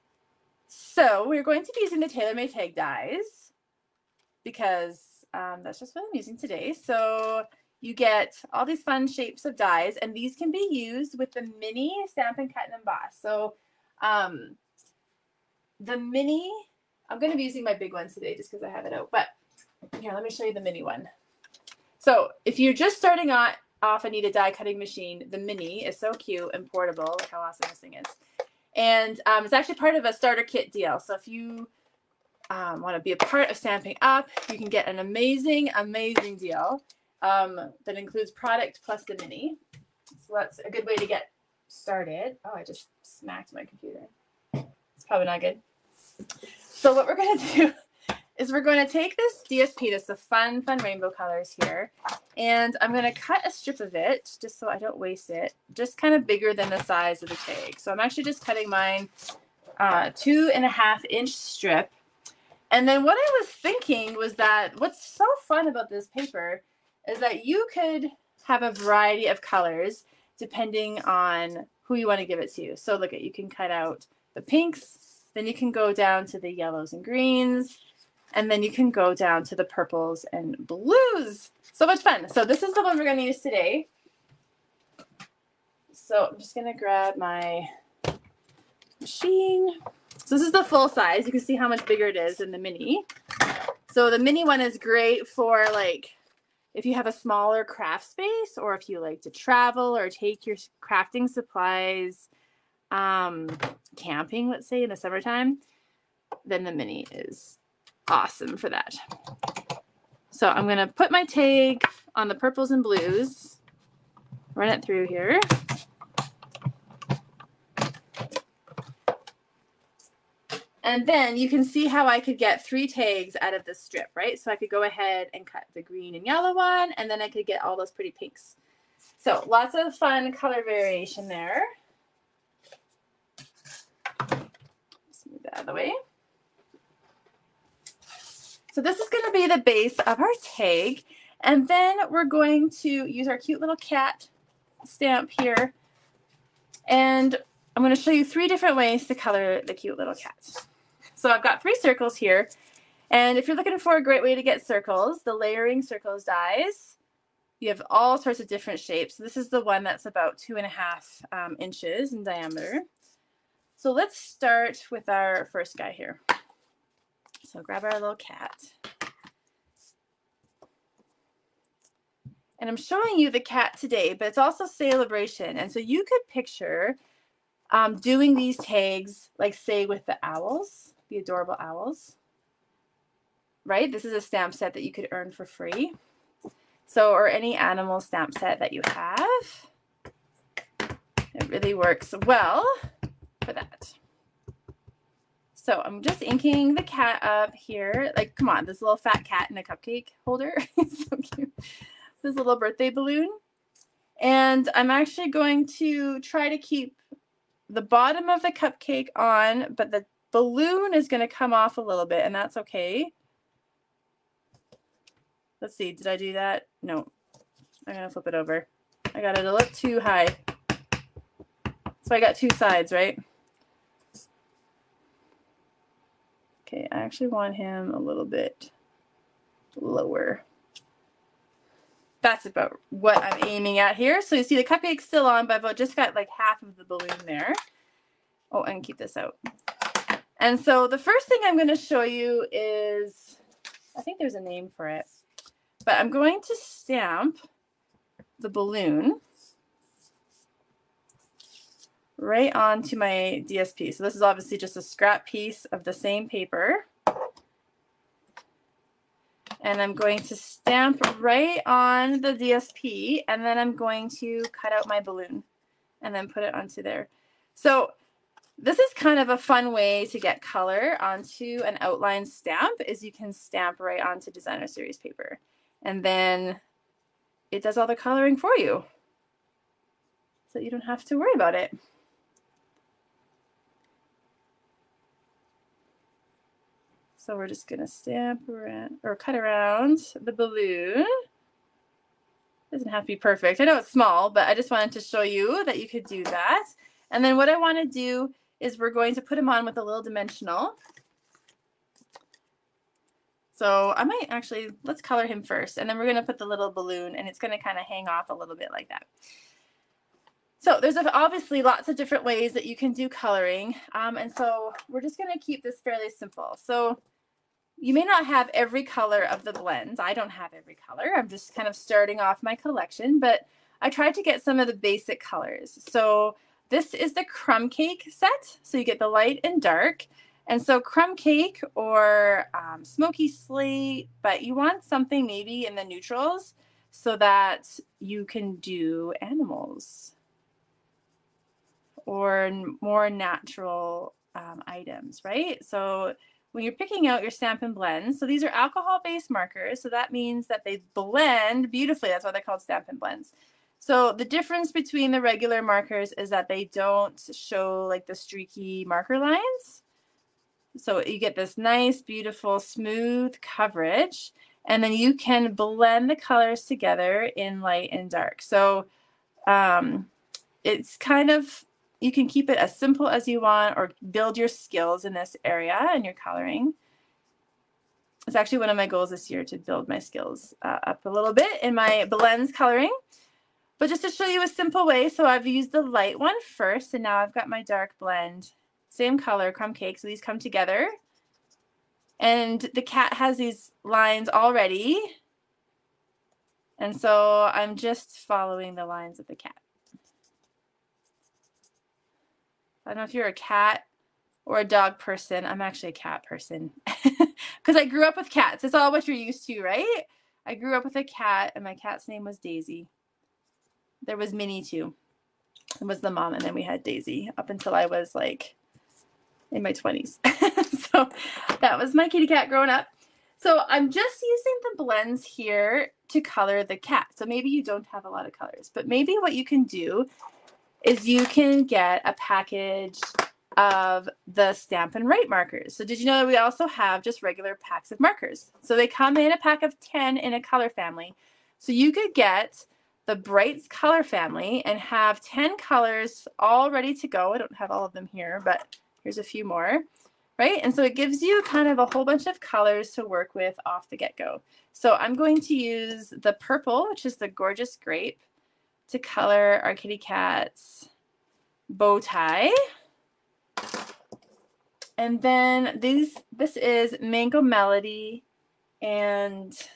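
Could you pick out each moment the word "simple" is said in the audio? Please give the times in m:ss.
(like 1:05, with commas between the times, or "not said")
5:16, 6:12, 6:24.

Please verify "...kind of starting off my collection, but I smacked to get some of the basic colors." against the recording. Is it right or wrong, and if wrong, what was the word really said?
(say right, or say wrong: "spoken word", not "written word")
wrong: "tried", not "smacked".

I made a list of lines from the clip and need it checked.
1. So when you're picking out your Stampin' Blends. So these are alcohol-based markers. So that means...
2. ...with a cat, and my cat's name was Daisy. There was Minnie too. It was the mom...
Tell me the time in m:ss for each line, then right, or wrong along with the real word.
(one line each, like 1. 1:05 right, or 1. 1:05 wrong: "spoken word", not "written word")
1. 5:45 right
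2. 6:50 right.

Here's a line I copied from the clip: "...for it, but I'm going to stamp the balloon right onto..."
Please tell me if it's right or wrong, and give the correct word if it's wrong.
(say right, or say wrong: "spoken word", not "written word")
right.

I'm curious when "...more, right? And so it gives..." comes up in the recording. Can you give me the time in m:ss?
7:29.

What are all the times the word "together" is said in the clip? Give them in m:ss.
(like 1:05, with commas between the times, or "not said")
6:06, 6:30.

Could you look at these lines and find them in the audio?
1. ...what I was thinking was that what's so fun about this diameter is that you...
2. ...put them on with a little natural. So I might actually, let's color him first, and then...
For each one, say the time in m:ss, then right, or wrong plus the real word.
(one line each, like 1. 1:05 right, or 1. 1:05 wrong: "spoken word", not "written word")
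1. 1:03 wrong: "paper", not "diameter"
2. 4:59 wrong: "dimensional", not "natural".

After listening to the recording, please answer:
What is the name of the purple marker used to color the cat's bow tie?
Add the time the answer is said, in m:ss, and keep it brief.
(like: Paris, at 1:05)
Gorgeous Grape, at 7:37.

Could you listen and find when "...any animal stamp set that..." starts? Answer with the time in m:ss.
3:07.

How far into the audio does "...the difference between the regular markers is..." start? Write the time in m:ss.
5:54.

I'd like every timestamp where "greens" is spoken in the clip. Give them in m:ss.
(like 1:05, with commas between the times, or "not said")
1:17, 2:05.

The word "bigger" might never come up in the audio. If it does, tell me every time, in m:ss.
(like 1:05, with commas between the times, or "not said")
0:56, 1:31.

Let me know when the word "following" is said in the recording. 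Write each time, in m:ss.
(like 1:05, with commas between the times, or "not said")
6:38.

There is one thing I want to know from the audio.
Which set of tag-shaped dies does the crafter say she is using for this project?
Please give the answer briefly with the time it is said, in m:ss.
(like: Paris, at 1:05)
Tailor Made tag dies, at 0:02.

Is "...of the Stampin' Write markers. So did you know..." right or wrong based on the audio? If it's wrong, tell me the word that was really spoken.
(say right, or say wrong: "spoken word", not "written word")
right.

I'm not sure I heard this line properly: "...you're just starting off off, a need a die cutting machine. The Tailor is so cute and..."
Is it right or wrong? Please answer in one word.
wrong.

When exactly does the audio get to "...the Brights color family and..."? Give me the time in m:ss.
7:23.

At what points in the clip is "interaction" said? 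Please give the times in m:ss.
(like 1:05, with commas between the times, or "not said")
not said.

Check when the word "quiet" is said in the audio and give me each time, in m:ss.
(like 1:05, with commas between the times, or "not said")
not said.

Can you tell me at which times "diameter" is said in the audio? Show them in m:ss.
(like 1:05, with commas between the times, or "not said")
2:42.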